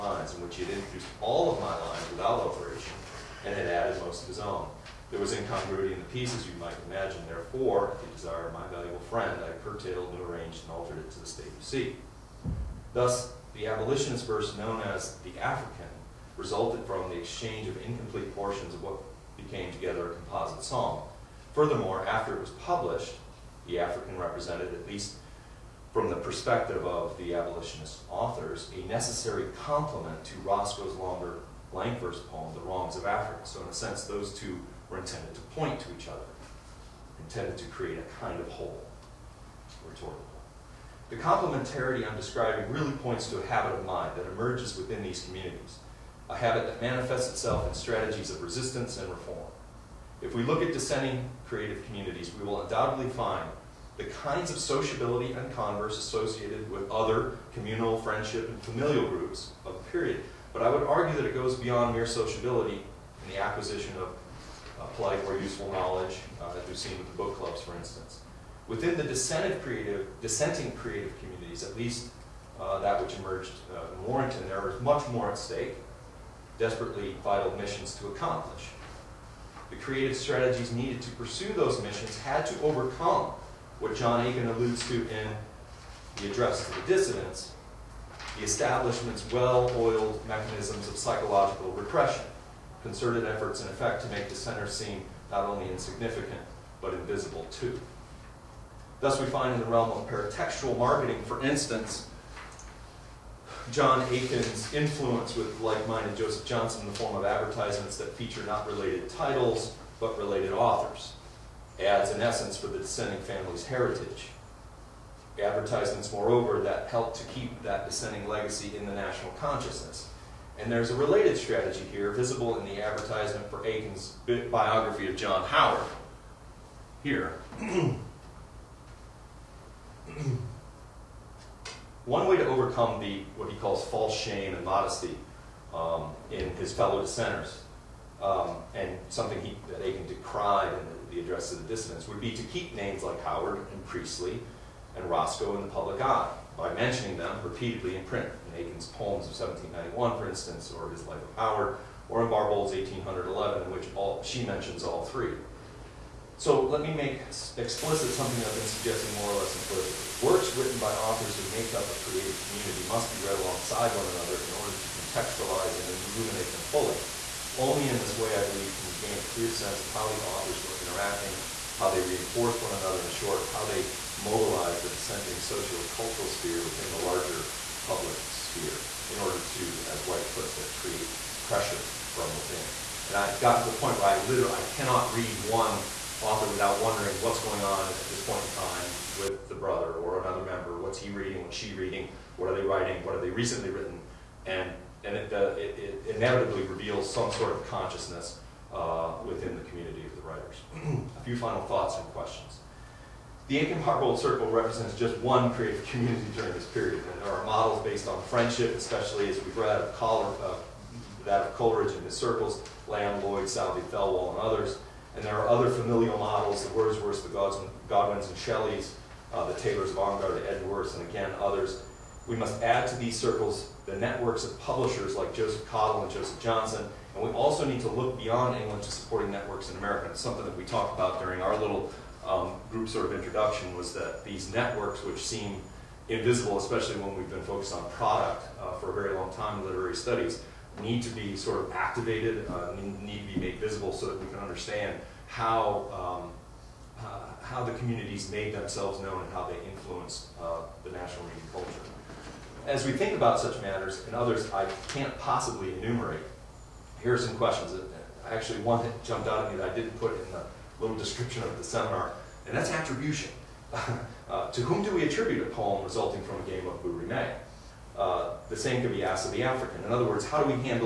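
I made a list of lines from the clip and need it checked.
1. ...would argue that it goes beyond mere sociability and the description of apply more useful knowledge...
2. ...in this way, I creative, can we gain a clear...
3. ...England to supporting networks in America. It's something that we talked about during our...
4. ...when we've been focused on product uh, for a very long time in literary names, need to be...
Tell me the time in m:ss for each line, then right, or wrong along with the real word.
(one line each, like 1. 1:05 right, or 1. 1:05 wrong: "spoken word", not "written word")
1. 1:00 wrong: "acquisition", not "description"
2. 2:47 wrong: "believe", not "creative"
3. 3:48 right
4. 3:56 wrong: "studies", not "names".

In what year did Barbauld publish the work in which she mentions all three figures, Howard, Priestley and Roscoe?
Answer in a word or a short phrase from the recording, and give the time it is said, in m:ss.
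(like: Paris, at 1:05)
1811, at 2:32.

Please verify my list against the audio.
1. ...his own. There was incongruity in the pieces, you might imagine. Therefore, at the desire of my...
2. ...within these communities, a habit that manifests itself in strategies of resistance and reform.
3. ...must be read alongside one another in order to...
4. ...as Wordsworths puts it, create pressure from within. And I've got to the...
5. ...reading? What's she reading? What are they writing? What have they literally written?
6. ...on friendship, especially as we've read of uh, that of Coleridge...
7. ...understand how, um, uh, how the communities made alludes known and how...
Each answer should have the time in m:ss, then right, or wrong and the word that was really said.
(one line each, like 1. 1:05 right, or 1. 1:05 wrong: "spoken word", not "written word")
1. 0:04 right
2. 0:44 right
3. 2:42 right
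4. 2:59 wrong: "White", not "Wordsworths"
5. 3:11 wrong: "recently", not "literally"
6. 3:28 right
7. 4:04 wrong: "themselves", not "alludes".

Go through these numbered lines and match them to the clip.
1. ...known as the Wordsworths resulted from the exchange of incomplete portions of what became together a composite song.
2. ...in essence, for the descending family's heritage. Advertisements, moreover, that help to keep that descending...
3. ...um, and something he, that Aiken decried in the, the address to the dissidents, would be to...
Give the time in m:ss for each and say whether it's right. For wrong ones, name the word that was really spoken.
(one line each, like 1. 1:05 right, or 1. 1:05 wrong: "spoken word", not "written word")
1. 0:14 wrong: "African", not "Wordsworths"
2. 1:52 right
3. 2:18 right.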